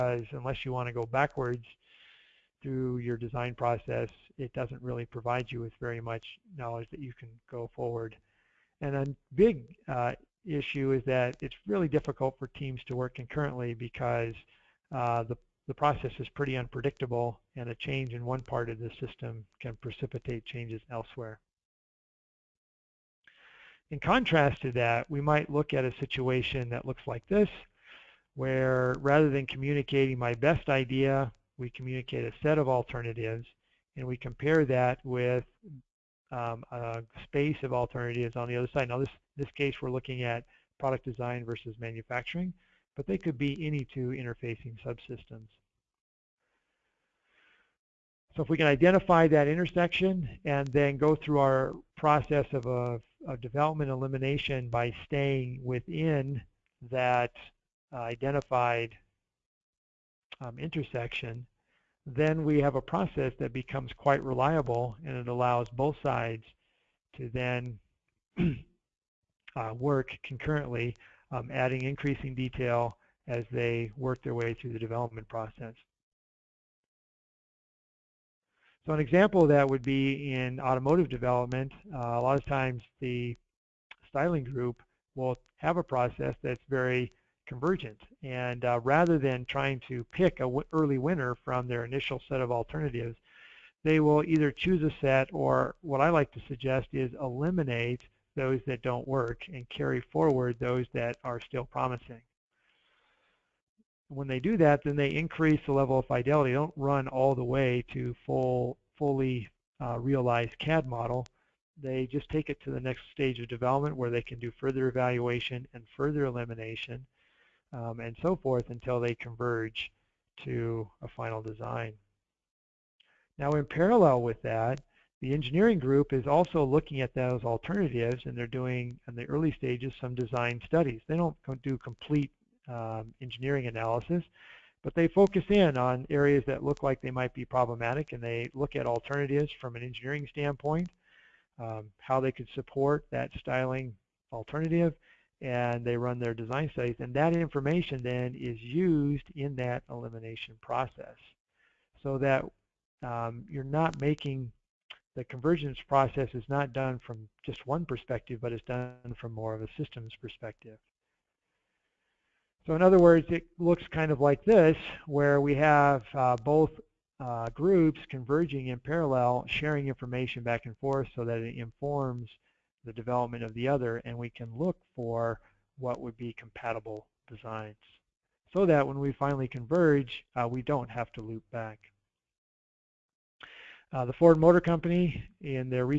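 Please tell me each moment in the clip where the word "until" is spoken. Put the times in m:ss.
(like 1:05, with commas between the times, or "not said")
1:58.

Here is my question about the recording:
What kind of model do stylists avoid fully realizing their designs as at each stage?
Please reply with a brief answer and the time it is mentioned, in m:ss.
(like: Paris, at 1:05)
CAD model, at 1:50.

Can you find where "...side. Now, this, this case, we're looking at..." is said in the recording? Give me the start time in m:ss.
0:38.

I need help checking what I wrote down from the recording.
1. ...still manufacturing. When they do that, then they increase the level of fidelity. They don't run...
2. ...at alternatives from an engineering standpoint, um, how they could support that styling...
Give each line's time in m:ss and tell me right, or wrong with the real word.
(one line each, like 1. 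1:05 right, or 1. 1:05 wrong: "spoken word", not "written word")
1. 1:41 wrong: "promising", not "manufacturing"
2. 2:18 right.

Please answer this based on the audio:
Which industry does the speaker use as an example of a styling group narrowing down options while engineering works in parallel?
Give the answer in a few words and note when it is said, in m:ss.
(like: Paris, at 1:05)
automotive development, at 1:20.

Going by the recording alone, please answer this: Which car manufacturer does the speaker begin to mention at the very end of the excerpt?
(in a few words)
Ford Motor Company.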